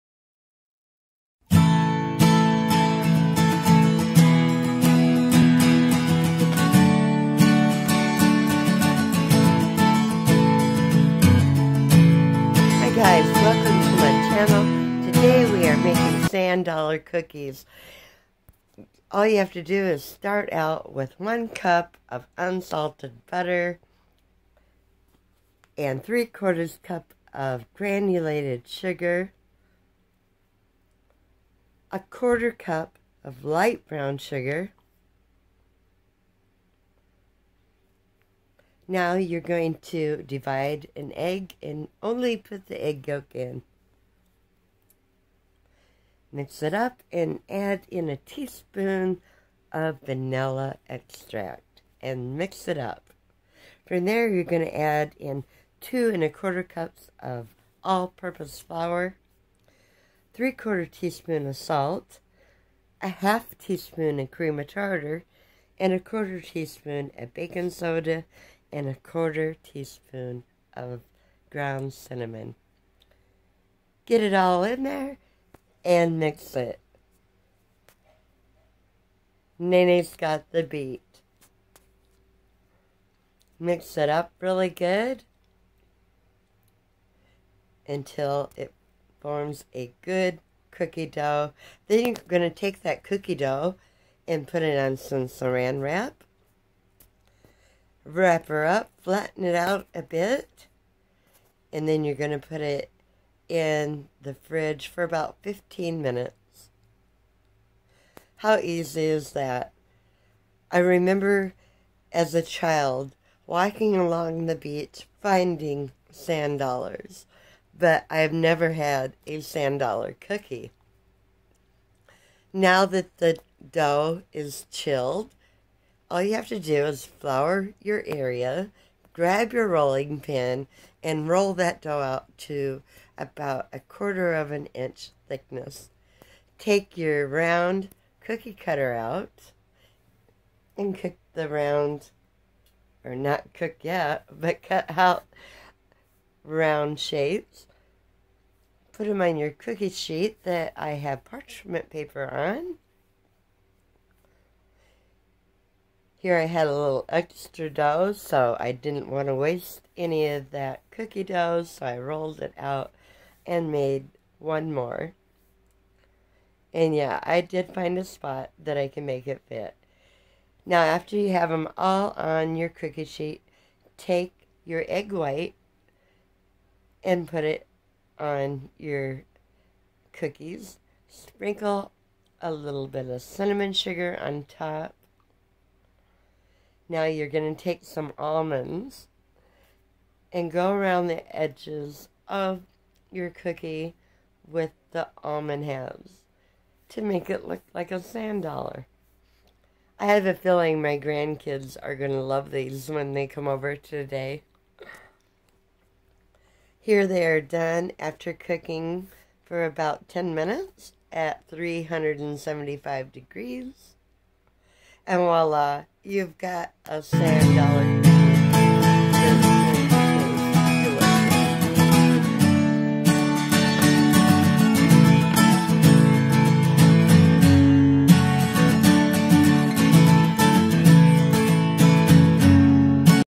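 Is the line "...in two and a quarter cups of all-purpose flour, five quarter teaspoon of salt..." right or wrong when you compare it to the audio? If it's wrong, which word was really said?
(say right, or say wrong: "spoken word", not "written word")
wrong: "three", not "five".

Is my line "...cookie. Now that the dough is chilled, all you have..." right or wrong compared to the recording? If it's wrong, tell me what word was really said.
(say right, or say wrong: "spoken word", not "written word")
right.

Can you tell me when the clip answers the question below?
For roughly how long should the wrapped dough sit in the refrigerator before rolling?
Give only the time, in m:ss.
1:45.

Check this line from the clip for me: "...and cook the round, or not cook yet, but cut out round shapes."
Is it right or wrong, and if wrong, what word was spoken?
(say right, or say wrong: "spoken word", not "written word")
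right.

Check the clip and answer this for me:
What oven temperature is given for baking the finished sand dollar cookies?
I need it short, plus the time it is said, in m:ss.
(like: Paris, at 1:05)
375 degrees, at 3:31.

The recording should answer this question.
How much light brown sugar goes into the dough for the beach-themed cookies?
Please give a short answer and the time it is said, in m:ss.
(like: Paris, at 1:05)
1/4 cup, at 0:31.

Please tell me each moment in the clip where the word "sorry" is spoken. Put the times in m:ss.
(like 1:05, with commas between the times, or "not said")
not said.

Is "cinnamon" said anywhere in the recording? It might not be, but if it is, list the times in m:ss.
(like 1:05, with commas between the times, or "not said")
1:11, 3:03.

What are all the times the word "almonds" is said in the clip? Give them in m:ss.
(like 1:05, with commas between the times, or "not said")
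3:08, 3:15.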